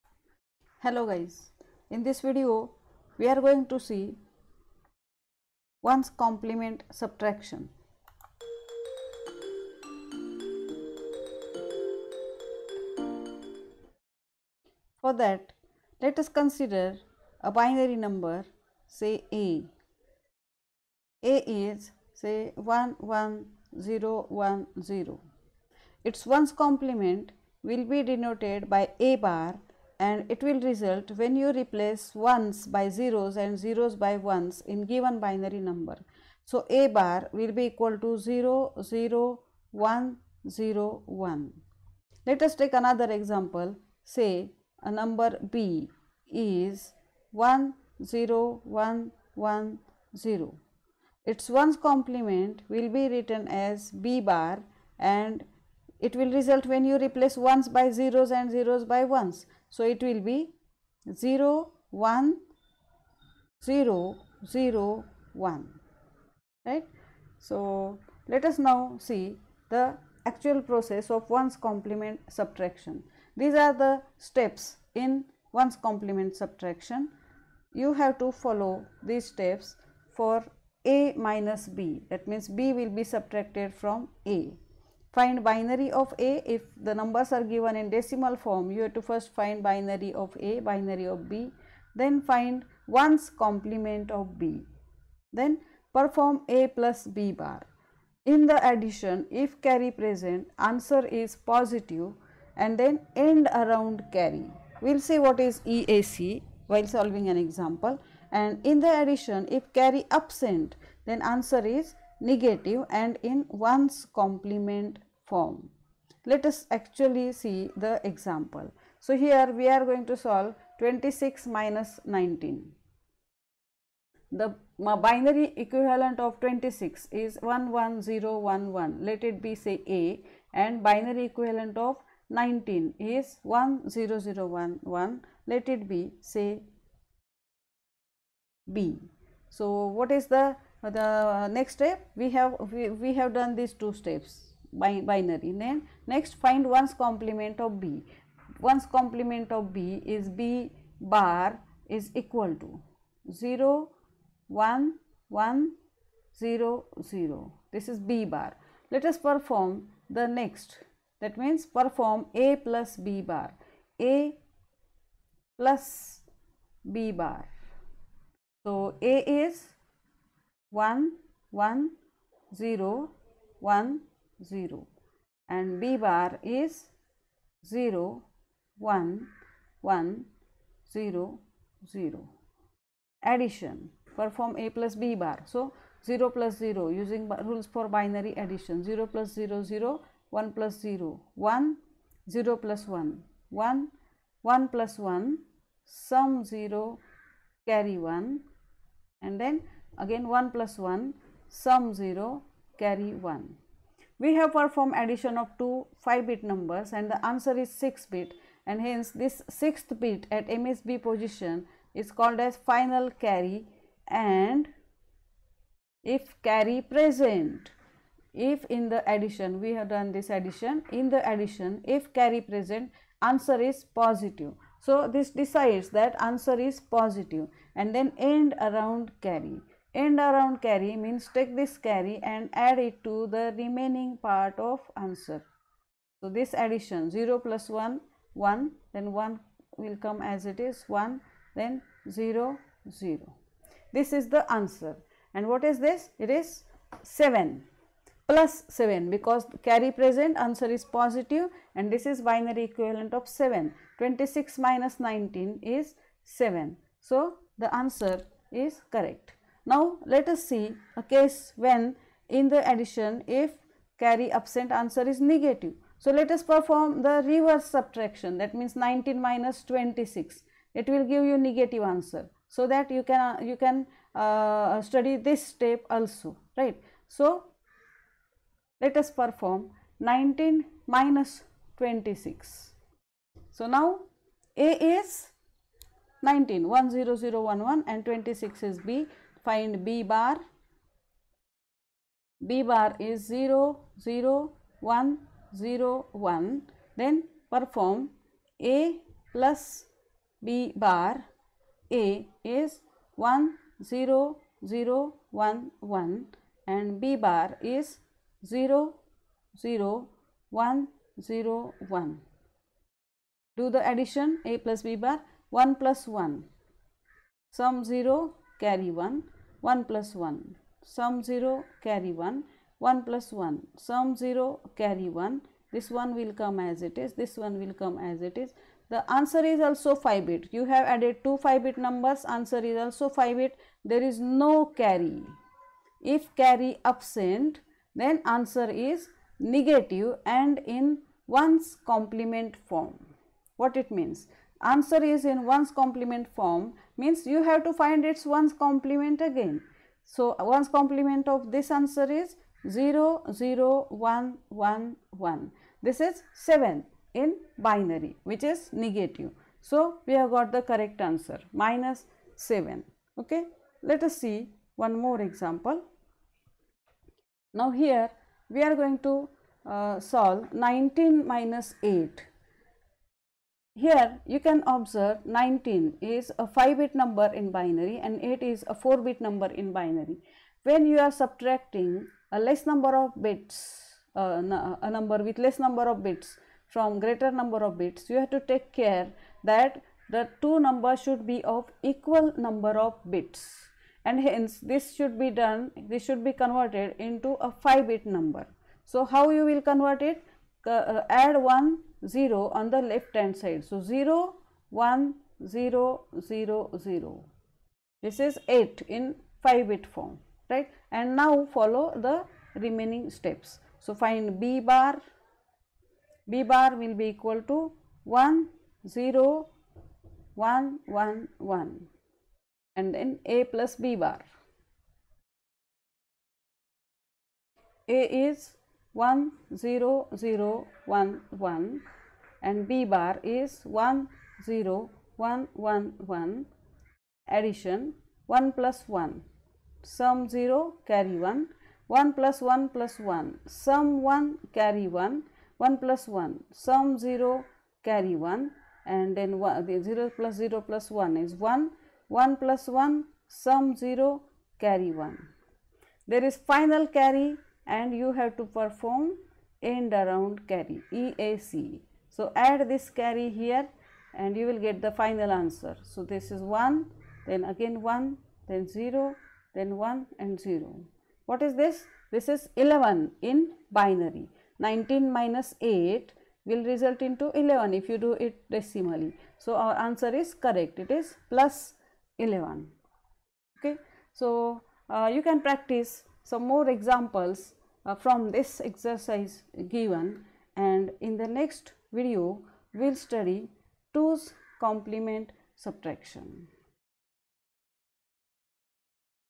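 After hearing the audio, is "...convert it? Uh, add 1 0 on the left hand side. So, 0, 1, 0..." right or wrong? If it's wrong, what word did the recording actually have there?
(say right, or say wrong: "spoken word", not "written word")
right.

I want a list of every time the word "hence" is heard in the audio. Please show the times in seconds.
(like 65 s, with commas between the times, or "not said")
208 s, 394 s.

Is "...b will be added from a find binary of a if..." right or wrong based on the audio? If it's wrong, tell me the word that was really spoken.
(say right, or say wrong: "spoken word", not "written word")
wrong: "subtracted", not "added".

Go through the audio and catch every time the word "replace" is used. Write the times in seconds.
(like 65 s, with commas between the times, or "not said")
31 s, 56 s.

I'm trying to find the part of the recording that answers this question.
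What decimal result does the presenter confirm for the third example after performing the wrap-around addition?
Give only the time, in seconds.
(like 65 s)
481 s.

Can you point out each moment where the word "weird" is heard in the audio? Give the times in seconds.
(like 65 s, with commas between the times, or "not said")
not said.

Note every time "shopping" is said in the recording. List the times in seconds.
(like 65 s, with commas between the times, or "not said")
not said.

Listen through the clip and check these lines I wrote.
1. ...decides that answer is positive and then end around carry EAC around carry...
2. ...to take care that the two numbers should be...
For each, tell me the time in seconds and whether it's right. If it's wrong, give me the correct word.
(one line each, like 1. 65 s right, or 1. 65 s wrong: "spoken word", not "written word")
1. 225 s wrong: "End", not "EAC"
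2. 388 s right.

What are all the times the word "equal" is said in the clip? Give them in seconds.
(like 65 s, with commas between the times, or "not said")
37 s, 152 s, 391 s, 417 s.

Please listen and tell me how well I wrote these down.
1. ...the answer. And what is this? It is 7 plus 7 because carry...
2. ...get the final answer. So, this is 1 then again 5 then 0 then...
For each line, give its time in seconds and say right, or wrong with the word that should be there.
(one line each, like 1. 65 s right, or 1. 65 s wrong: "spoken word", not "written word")
1. 244 s right
2. 464 s wrong: "1", not "5".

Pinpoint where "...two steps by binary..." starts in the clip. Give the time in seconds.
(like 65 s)
143 s.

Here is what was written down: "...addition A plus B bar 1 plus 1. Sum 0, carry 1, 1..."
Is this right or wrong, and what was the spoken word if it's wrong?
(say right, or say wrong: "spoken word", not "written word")
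right.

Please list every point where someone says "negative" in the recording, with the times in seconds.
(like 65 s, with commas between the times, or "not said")
112 s, 265 s, 271 s, 339 s, 358 s.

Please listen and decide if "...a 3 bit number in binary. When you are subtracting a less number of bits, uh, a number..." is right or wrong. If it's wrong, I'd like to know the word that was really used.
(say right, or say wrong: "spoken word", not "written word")
wrong: "4", not "3".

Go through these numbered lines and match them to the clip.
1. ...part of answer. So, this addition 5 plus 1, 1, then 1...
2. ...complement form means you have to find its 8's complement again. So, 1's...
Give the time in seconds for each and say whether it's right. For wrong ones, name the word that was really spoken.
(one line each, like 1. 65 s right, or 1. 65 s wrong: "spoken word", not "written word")
1. 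234 s wrong: "0", not "5"
2. 345 s wrong: "1", not "8".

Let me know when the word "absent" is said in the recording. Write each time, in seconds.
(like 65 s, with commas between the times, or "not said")
110 s, 264 s, 336 s.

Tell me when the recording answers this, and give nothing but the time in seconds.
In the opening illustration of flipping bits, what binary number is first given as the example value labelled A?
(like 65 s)
22 s.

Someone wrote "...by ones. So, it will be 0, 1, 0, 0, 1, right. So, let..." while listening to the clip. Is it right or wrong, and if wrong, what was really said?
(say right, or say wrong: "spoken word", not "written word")
right.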